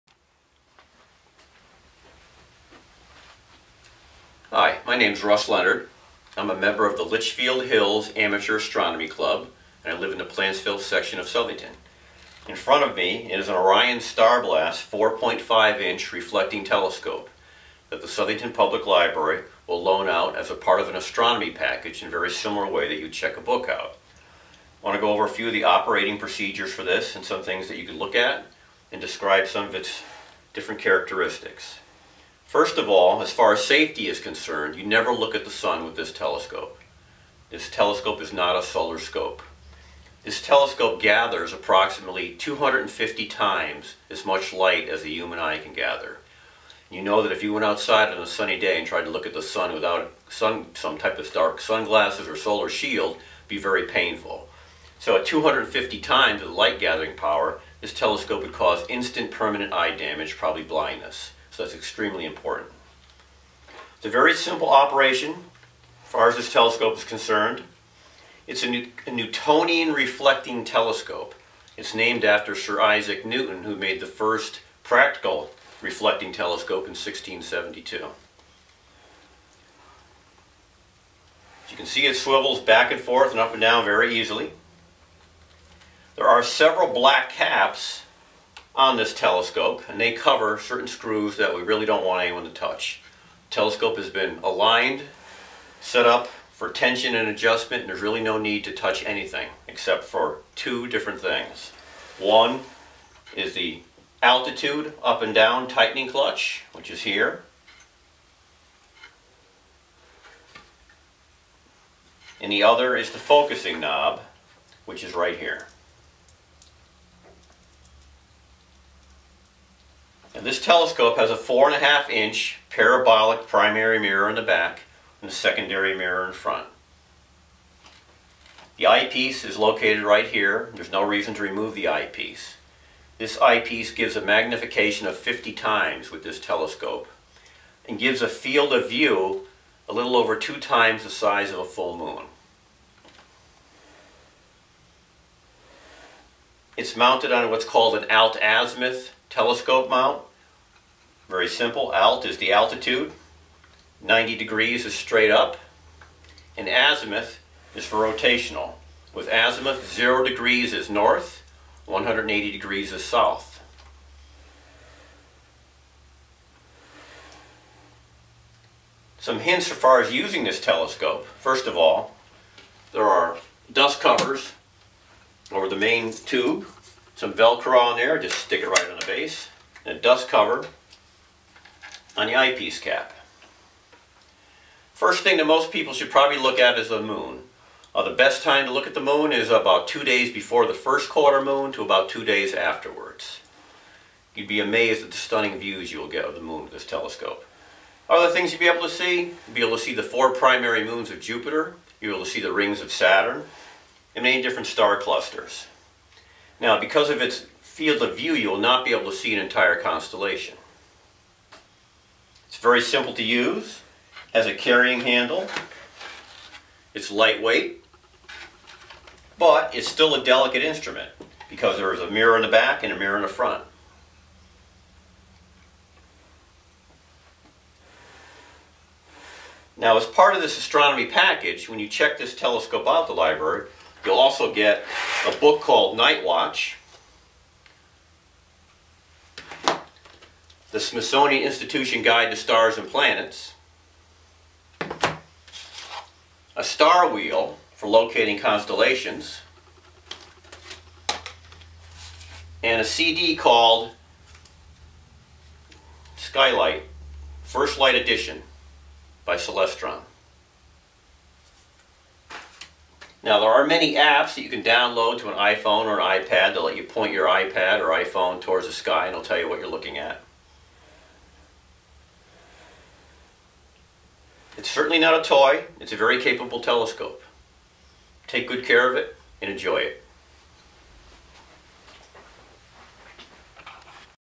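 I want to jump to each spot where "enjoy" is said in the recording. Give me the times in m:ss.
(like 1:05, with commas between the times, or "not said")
4:39.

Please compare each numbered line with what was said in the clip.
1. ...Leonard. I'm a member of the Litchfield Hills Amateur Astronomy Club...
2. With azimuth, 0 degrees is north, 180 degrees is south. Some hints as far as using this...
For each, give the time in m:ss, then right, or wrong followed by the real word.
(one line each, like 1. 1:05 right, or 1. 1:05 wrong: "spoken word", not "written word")
1. 0:05 right
2. 2:39 right.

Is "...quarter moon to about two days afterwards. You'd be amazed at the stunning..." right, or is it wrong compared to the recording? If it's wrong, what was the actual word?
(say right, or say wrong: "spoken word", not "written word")
right.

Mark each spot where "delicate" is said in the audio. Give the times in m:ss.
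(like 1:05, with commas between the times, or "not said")
3:40.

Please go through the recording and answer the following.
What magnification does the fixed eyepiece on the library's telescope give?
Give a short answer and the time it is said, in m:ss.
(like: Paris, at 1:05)
50 times, at 2:15.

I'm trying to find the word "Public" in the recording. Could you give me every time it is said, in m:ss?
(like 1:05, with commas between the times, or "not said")
0:18.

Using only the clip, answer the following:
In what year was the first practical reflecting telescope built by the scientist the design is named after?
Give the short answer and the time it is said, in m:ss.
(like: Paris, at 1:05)
1672, at 1:16.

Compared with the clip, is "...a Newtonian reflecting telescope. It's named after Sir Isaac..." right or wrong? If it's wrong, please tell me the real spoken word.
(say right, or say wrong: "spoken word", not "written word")
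right.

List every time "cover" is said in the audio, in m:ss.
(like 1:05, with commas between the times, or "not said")
1:30, 2:53, 3:00.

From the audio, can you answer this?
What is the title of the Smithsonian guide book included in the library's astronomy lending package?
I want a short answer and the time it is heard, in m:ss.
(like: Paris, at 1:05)
Night Watch, at 3:55.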